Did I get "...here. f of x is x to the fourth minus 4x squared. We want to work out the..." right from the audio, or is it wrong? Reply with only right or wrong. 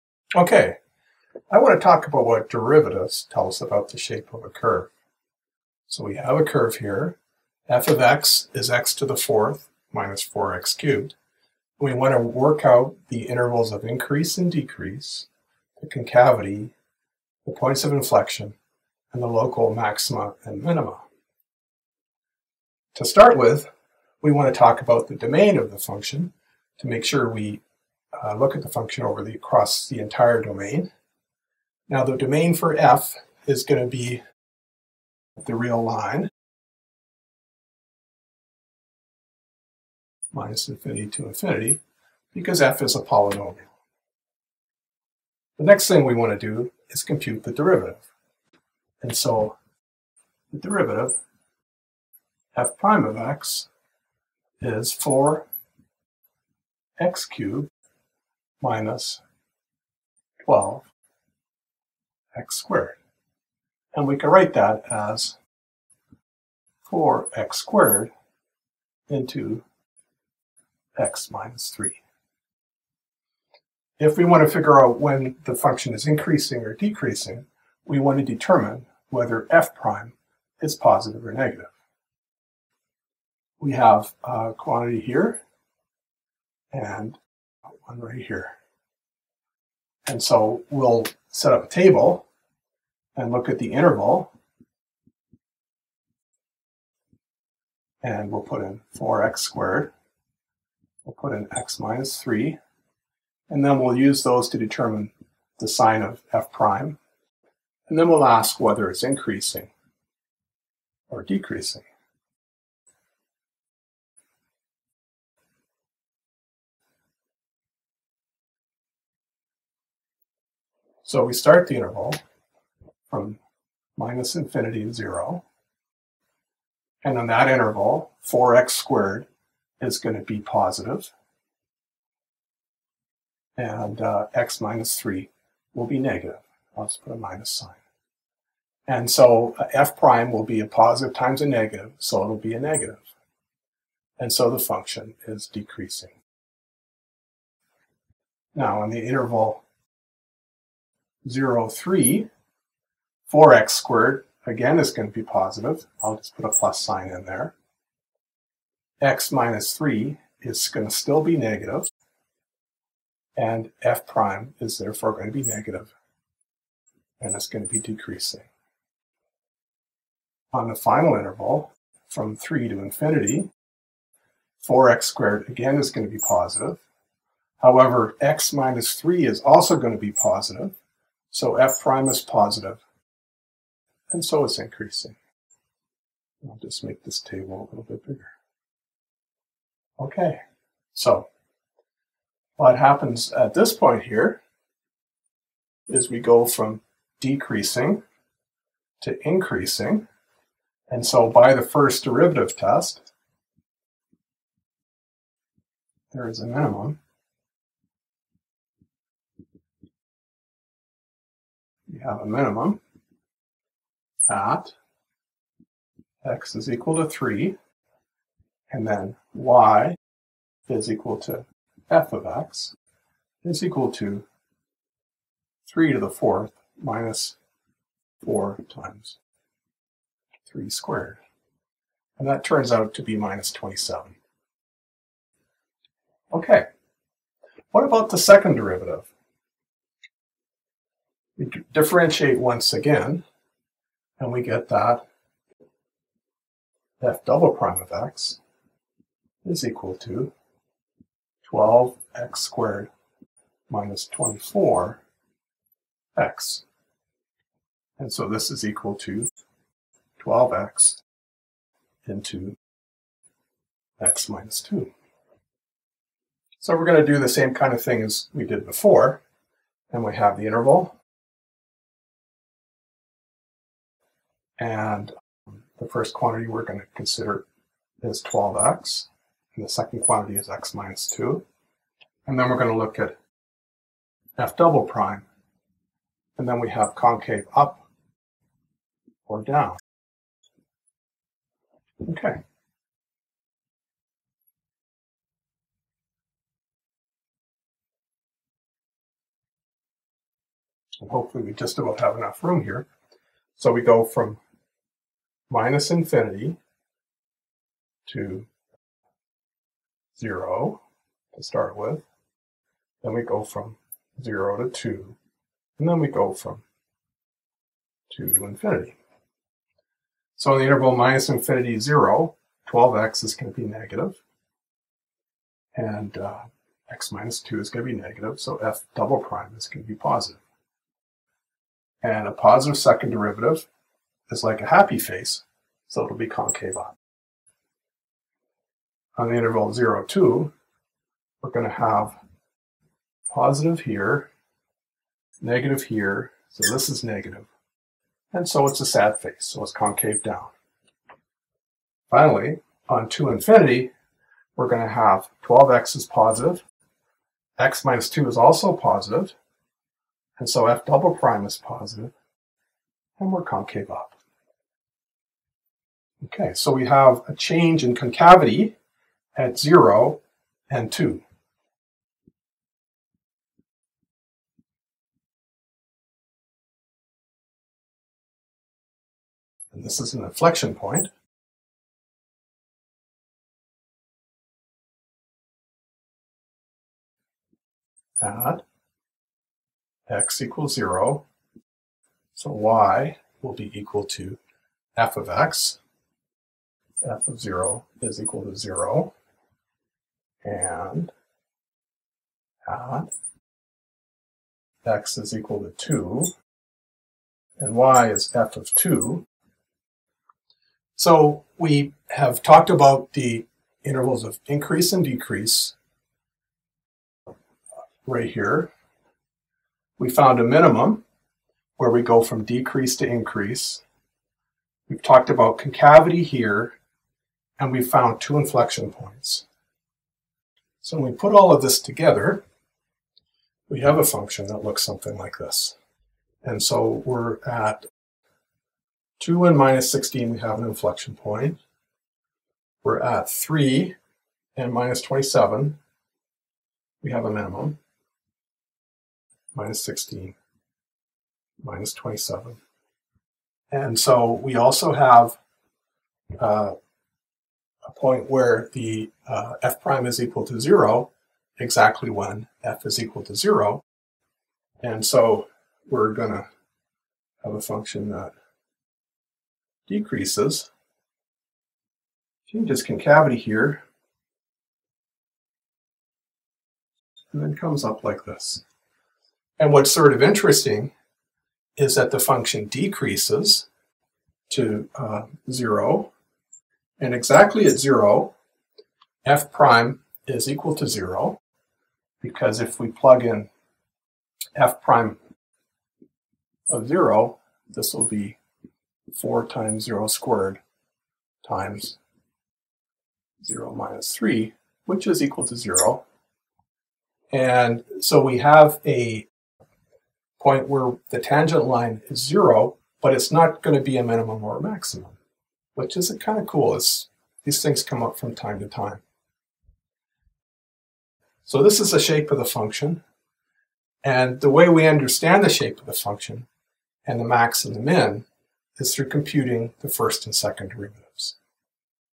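wrong.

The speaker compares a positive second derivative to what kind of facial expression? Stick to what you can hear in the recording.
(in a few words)
a happy face.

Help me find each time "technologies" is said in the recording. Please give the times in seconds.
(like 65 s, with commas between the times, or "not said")
not said.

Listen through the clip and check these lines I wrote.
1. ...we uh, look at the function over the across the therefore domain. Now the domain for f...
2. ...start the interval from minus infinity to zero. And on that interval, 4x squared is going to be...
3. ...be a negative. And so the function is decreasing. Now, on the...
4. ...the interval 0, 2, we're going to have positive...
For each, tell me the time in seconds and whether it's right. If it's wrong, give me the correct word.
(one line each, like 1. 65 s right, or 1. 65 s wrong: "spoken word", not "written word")
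1. 27 s wrong: "entire", not "therefore"
2. 121 s right
3. 142 s right
4. 339 s right.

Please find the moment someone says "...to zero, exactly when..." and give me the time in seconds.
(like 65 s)
460 s.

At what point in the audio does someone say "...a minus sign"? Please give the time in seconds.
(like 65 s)
137 s.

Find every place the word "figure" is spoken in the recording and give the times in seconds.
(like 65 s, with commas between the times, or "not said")
74 s.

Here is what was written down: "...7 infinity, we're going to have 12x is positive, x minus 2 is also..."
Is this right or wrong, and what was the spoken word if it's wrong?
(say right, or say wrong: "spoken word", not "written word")
wrong: "2", not "7".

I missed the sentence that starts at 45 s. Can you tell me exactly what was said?
The next thing we want to do is compute the derivative.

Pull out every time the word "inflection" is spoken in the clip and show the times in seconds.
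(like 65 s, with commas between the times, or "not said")
17 s, 380 s, 428 s, 440 s.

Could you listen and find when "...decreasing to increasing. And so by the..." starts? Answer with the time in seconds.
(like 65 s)
197 s.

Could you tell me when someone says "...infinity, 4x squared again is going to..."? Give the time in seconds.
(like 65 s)
172 s.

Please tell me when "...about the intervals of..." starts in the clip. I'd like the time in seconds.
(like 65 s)
412 s.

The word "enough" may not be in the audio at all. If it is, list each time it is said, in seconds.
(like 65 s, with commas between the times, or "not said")
302 s.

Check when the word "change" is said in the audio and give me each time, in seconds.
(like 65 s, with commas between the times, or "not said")
367 s, 472 s.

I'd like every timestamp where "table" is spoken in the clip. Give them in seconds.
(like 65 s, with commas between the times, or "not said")
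91 s, 187 s.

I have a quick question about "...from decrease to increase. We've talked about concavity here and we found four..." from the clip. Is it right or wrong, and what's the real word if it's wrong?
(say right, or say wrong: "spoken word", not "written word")
wrong: "two", not "four".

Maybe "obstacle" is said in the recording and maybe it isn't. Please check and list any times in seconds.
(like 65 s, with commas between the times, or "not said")
not said.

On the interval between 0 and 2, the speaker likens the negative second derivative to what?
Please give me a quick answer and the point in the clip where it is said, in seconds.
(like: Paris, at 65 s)
a sad face, at 348 s.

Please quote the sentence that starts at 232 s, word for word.
And that turns out to be minus 27.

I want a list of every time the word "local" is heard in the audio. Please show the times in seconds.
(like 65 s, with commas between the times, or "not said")
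19 s.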